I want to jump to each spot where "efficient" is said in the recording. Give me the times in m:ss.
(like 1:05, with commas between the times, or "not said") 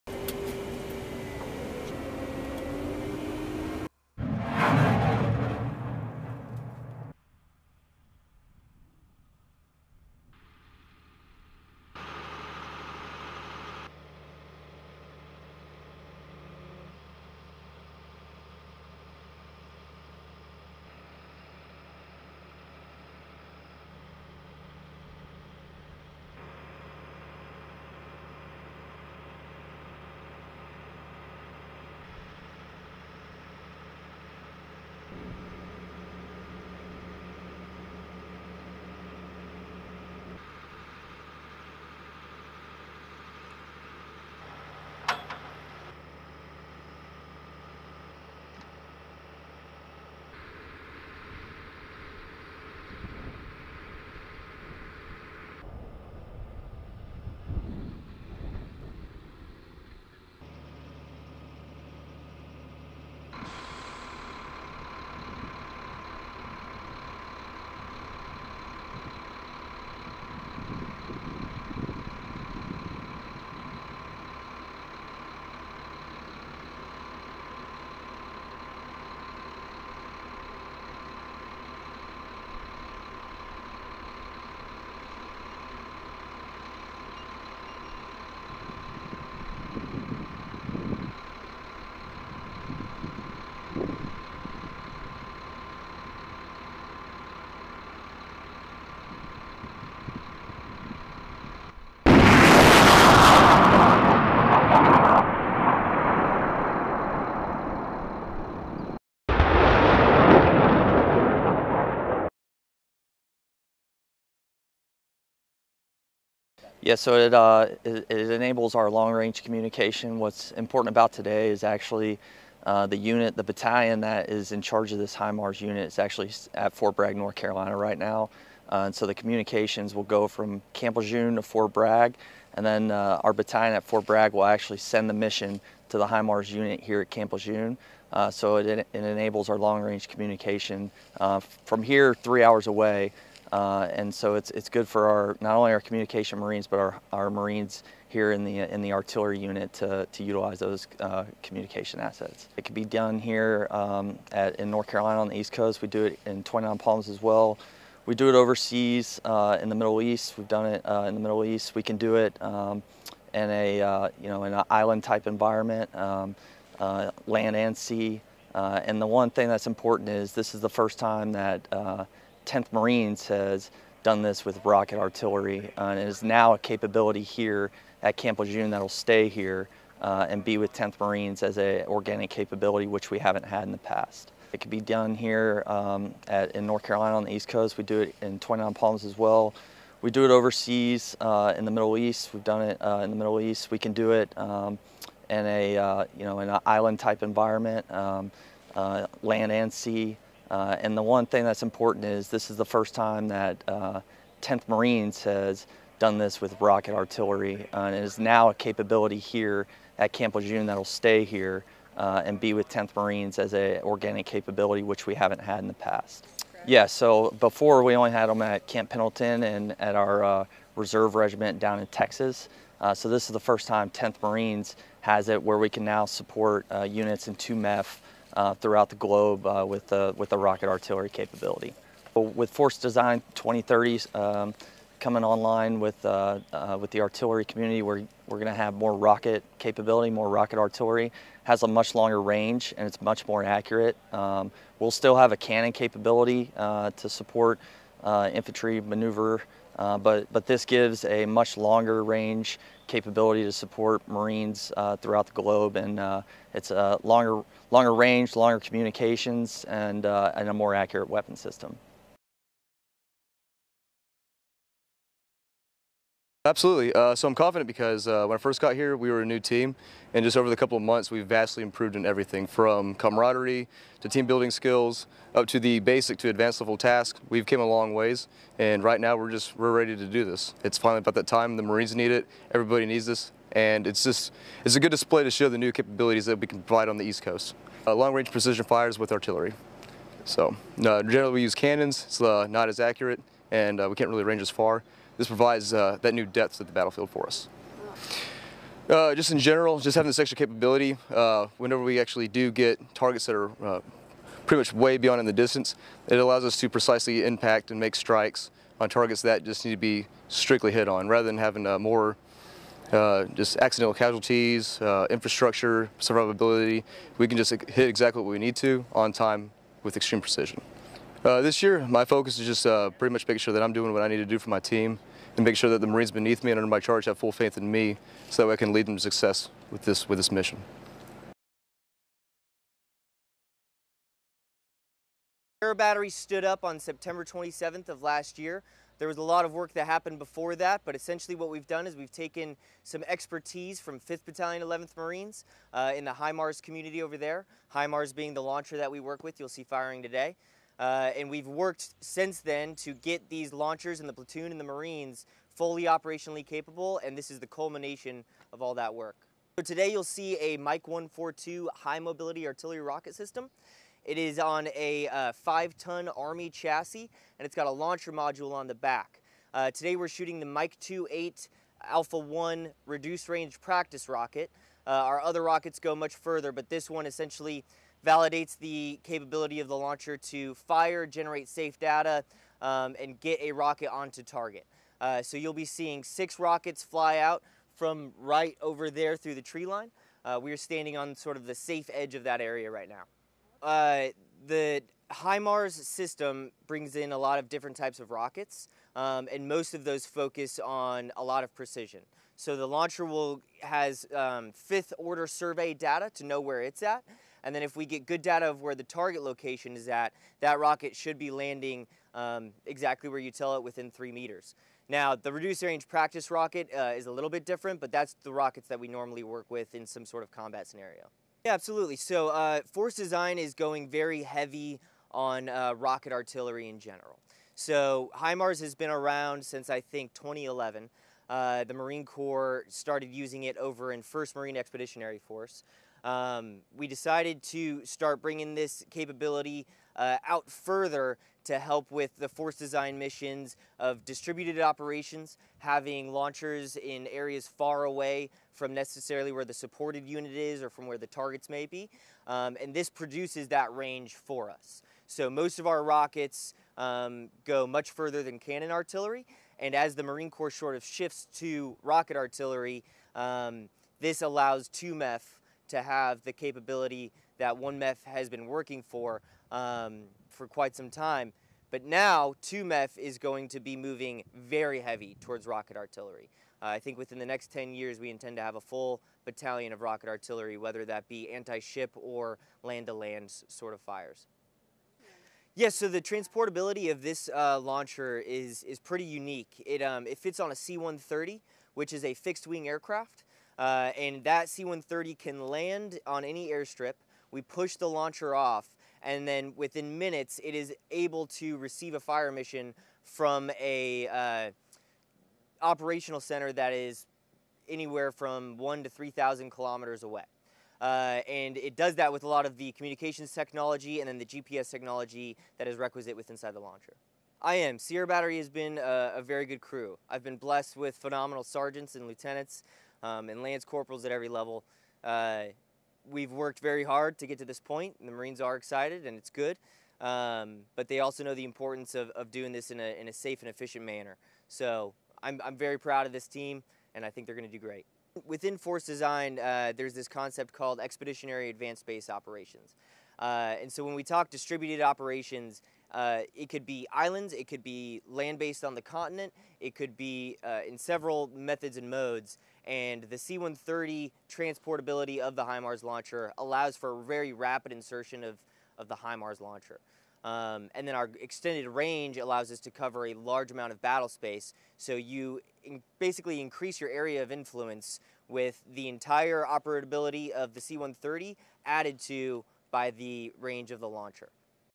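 8:53.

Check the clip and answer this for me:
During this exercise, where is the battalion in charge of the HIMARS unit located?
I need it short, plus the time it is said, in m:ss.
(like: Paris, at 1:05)
Fort Bragg, North Carolina, at 2:06.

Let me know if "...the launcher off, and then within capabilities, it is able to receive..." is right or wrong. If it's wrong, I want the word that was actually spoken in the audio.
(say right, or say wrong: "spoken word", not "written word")
wrong: "minutes", not "capabilities".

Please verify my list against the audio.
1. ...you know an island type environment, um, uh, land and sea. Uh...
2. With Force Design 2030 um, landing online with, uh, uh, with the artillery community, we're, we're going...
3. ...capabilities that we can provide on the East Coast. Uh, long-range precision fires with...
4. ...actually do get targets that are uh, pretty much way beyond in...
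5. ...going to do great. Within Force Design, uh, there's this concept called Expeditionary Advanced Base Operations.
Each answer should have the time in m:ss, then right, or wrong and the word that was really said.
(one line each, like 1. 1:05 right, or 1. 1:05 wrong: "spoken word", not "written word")
1. 3:16 right
2. 3:52 wrong: "coming", not "landing"
3. 4:45 right
4. 5:01 right
5. 8:57 right.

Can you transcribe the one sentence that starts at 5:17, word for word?
We can just hit exactly what we need to on time with extreme precision.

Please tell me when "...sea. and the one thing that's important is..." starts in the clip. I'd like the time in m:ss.
2:47.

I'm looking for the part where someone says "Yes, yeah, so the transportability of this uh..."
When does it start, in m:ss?
8:05.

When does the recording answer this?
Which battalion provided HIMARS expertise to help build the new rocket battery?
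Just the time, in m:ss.
5:43.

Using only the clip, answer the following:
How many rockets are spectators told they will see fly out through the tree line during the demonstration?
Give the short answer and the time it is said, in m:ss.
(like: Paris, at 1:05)
6, at 6:26.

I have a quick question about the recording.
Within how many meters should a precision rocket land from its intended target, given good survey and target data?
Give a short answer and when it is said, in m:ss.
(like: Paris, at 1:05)
3, at 6:53.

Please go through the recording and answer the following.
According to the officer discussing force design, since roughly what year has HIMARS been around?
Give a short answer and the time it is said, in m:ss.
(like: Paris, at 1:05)
2011, at 7:10.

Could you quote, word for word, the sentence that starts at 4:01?
has a much longer range and it's much more accurate.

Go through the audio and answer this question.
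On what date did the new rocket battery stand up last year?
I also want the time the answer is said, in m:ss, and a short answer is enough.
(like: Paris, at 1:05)
September 27, at 5:36.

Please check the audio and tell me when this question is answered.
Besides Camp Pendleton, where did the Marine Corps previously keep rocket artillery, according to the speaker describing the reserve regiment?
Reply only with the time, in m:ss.
3:41.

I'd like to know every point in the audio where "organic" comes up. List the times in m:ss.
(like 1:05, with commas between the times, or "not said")
3:01, 3:33.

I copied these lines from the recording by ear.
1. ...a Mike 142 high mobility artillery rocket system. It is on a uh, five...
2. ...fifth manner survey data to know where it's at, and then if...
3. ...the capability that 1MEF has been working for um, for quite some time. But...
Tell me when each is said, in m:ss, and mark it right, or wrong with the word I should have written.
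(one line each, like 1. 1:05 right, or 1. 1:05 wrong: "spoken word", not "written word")
1. 6:00 right
2. 6:44 wrong: "order", not "manner"
3. 7:46 right.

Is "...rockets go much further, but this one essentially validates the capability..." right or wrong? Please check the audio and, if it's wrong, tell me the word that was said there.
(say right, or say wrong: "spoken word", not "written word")
right.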